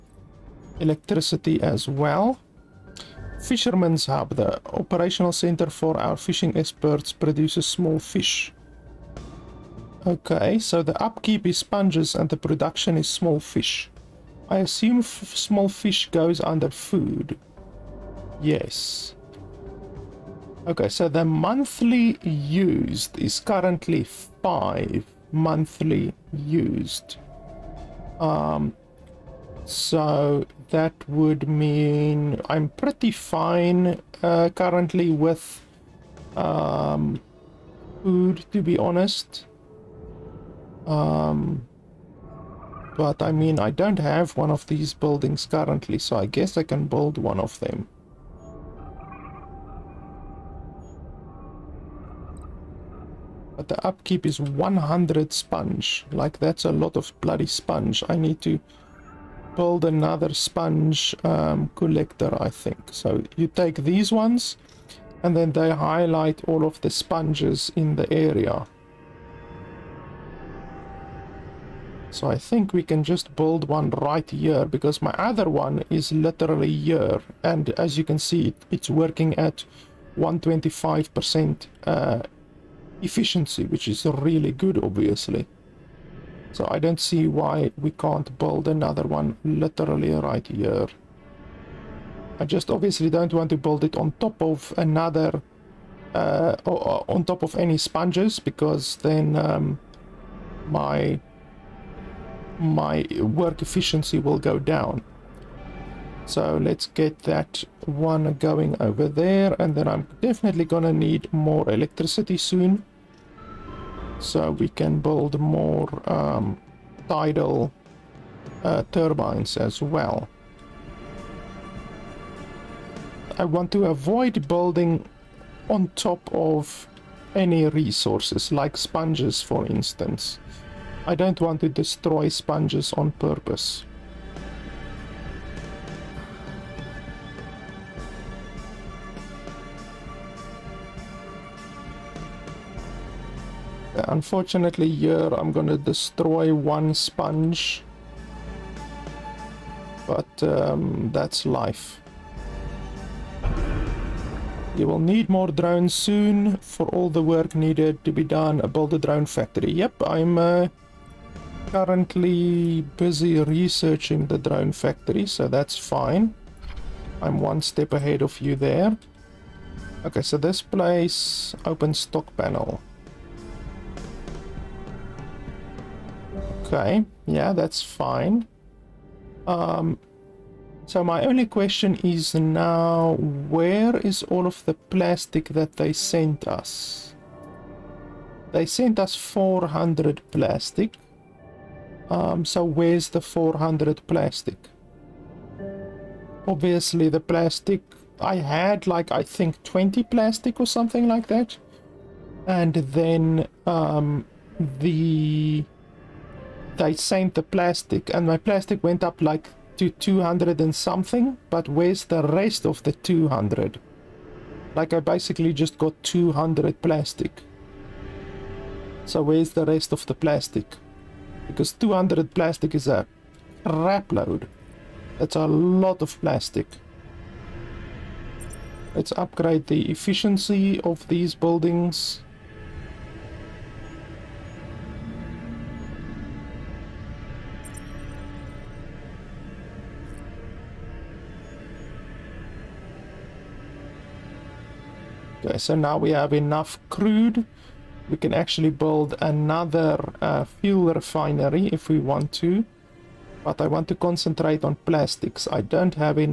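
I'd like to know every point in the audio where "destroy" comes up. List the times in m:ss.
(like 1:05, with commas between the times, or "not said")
2:11, 2:25.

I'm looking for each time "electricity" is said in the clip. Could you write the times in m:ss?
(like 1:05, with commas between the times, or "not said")
0:00, 1:51.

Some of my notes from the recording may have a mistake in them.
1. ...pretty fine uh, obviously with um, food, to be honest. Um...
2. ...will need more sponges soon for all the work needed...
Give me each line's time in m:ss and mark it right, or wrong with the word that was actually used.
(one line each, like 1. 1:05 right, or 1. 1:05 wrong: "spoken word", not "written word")
1. 0:32 wrong: "currently", not "obviously"
2. 2:34 wrong: "drones", not "sponges".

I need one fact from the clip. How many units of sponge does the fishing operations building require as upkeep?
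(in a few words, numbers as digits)
100.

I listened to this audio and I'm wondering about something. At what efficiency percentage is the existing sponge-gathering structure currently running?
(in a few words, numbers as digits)
125%.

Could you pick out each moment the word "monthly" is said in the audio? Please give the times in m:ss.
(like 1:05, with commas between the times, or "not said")
0:21, 0:25.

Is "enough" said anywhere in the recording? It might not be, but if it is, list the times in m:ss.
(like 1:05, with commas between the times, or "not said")
4:06.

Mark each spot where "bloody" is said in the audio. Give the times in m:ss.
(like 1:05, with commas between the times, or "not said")
0:57.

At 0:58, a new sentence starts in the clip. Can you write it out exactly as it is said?
I need to build another sponge um, collector, I think.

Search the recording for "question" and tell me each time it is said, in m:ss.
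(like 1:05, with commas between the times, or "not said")
3:01.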